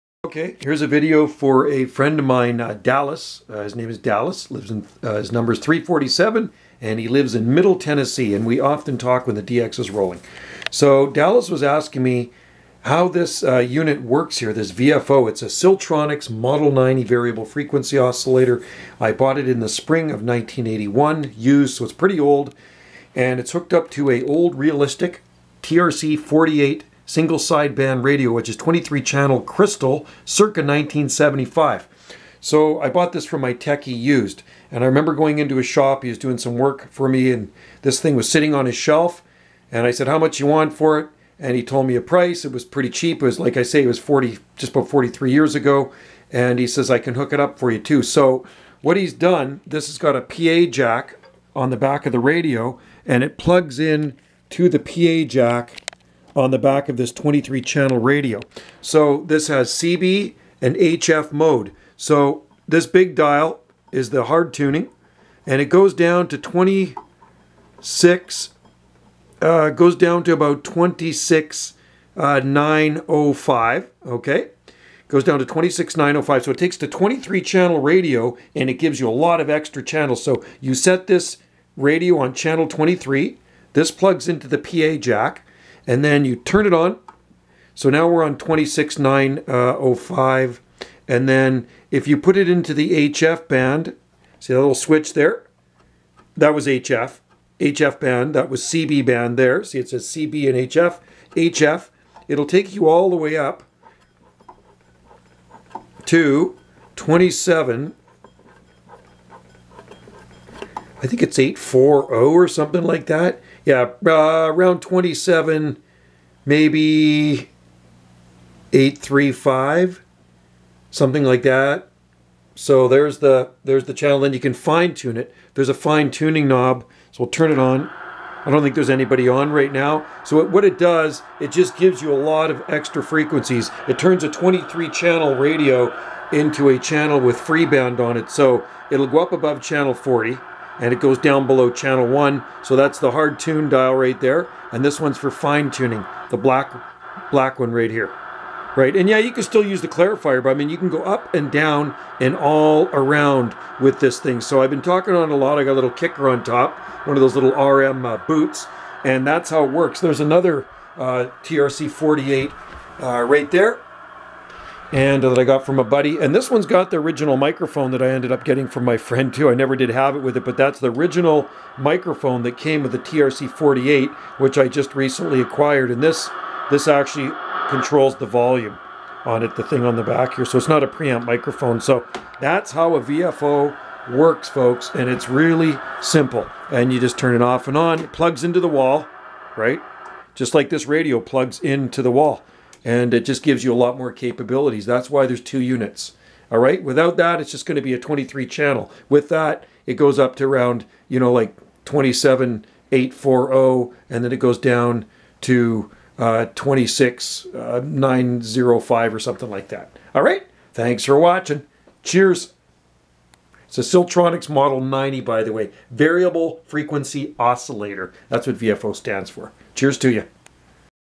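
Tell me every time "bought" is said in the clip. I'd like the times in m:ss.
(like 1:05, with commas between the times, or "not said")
0:19, 0:32.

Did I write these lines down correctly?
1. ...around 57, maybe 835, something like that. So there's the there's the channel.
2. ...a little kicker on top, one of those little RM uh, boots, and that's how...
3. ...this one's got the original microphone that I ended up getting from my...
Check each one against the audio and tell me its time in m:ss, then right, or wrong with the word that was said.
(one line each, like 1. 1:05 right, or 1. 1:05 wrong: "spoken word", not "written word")
1. 1:54 wrong: "27", not "57"
2. 2:35 right
3. 2:46 right.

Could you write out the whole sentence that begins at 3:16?
All right, without that, it's just going to be a 23 channel.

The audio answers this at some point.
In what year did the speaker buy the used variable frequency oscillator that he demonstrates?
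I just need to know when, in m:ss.
0:20.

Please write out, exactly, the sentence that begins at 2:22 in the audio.
So that's the hard tune dial right there.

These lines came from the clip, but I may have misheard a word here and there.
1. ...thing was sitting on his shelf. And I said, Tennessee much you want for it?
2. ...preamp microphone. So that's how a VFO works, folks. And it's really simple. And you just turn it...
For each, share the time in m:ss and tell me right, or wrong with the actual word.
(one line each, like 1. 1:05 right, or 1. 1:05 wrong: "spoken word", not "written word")
1. 0:37 wrong: "How", not "Tennessee"
2. 3:00 right.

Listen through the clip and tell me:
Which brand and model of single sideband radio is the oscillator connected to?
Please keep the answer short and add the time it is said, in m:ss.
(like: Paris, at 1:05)
Realistic TRC 48, at 0:24.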